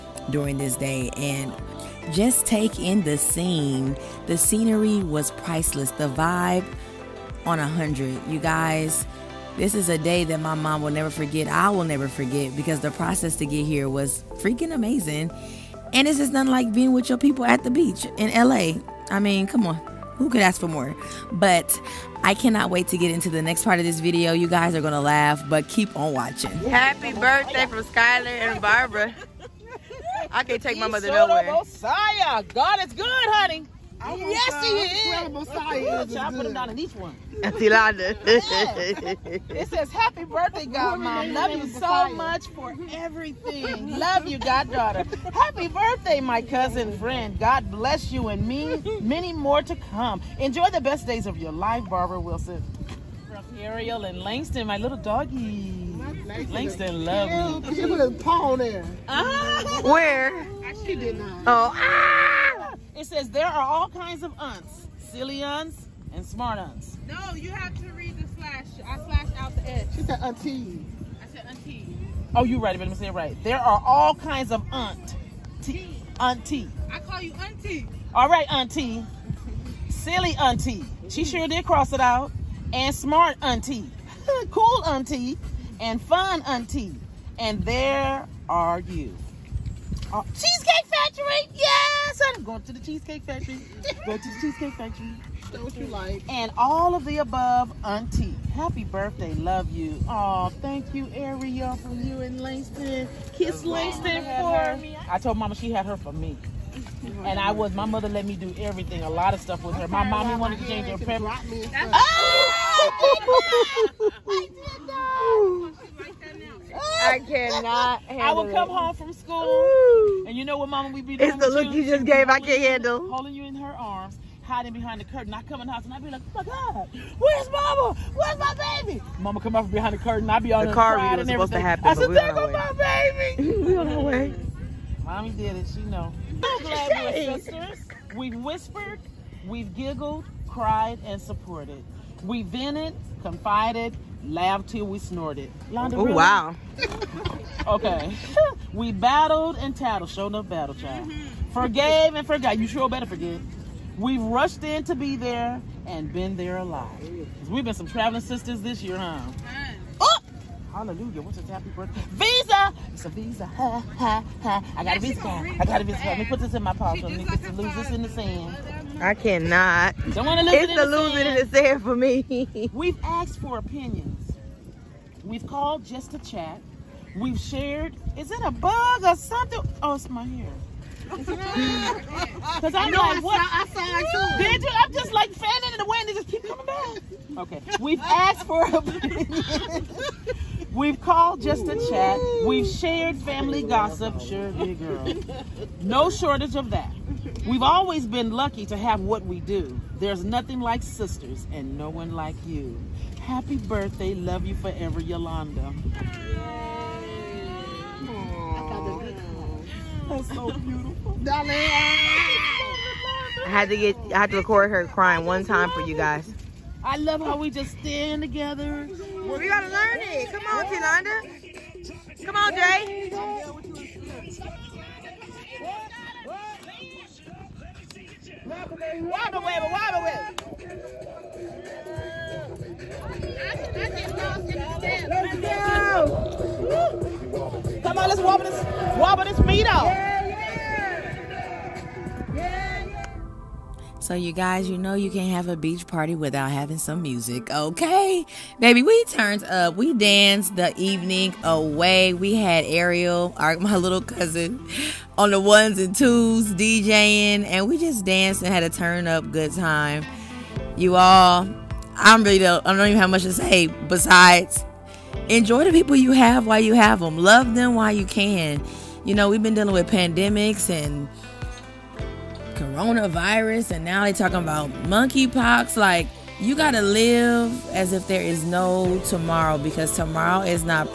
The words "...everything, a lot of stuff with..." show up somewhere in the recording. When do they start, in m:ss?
1:48.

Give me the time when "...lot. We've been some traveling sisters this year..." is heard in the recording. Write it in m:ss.
2:36.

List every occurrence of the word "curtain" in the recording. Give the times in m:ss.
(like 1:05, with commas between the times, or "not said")
2:05, 2:09.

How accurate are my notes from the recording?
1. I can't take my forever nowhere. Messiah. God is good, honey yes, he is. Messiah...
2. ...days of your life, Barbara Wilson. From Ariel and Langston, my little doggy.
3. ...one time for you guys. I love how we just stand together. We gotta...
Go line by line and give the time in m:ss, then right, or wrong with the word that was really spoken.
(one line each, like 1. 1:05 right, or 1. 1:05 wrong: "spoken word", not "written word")
1. 0:30 wrong: "mother", not "forever"
2. 0:51 right
3. 3:35 right.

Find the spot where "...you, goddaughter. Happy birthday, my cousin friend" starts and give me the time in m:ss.
0:44.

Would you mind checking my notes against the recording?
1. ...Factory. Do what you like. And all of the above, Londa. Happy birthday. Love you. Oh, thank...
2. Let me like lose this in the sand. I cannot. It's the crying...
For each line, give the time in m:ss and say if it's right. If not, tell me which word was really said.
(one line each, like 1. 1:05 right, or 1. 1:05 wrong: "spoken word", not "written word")
1. 1:34 wrong: "Auntie", not "Londa"
2. 2:47 wrong: "losing", not "crying".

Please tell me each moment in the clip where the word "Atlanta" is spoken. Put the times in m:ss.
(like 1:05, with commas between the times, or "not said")
not said.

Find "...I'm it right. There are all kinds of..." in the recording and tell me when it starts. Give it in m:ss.
1:12.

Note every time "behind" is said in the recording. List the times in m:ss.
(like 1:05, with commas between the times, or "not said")
2:04, 2:09.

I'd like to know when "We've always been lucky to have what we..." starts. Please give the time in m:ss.
3:17.